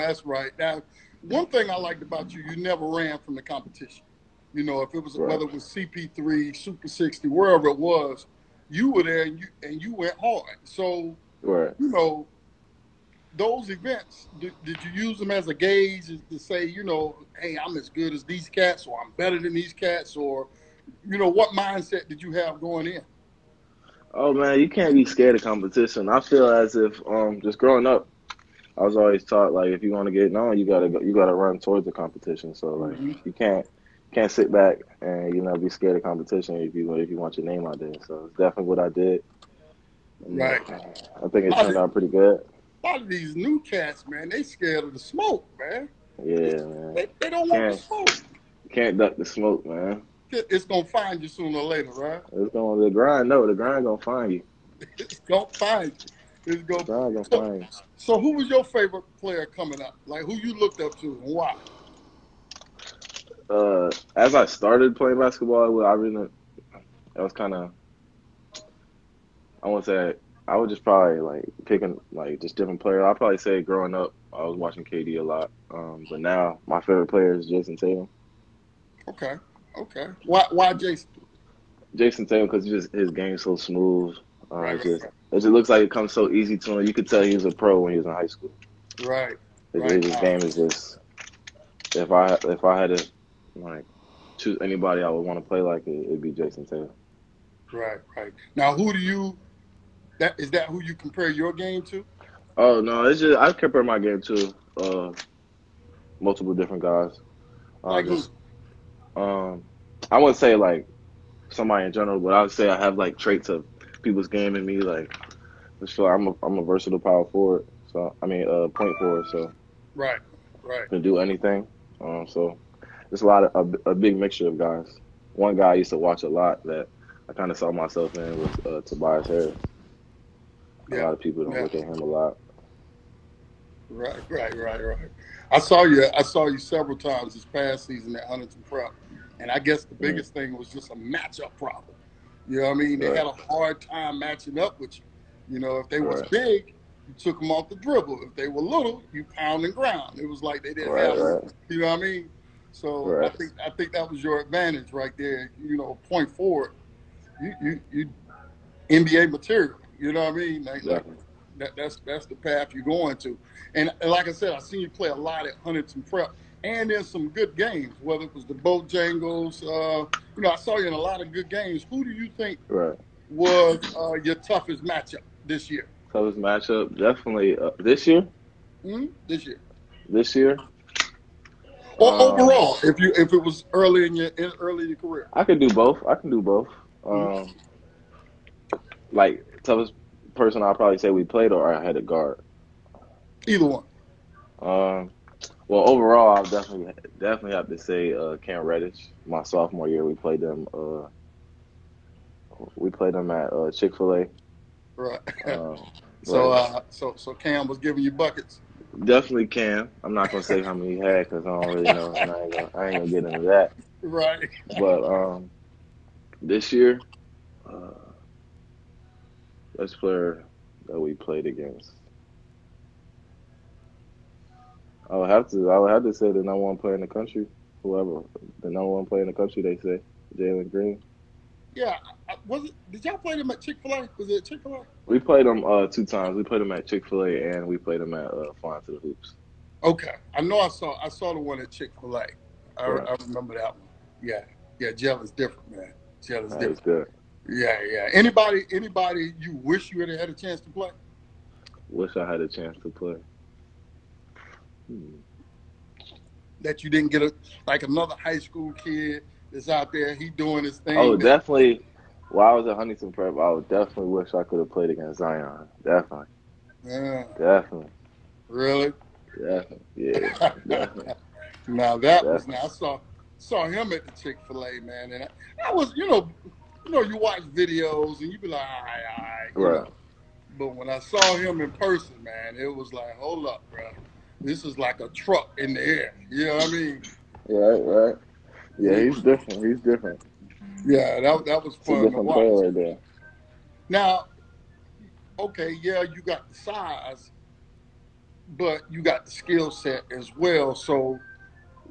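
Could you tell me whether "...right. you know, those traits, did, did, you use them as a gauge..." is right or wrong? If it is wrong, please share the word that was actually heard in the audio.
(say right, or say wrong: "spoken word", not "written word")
wrong: "events", not "traits".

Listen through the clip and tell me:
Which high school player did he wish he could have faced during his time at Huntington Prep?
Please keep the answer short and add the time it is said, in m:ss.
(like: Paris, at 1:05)
Zion, at 4:25.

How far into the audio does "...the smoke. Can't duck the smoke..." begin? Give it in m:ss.
0:47.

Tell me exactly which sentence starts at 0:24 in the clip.
Oh man, you can't be scared of competition.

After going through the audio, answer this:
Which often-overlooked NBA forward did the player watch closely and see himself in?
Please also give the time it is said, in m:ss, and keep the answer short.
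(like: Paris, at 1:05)
Tobias Harris, at 2:08.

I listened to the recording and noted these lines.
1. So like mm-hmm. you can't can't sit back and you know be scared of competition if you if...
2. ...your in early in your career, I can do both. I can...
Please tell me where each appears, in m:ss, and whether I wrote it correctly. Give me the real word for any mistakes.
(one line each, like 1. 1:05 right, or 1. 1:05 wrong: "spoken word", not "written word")
1. 0:32 right
2. 3:04 right.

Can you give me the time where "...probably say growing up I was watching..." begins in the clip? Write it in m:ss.
1:13.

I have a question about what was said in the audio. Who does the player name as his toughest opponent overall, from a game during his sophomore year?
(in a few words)
Cam Reddish.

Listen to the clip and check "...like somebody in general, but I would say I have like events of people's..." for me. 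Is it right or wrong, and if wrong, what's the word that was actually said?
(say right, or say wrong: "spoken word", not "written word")
wrong: "traits", not "events".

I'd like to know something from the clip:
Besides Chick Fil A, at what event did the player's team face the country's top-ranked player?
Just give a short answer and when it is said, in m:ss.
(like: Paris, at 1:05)
Flying to the Hoops, at 3:58.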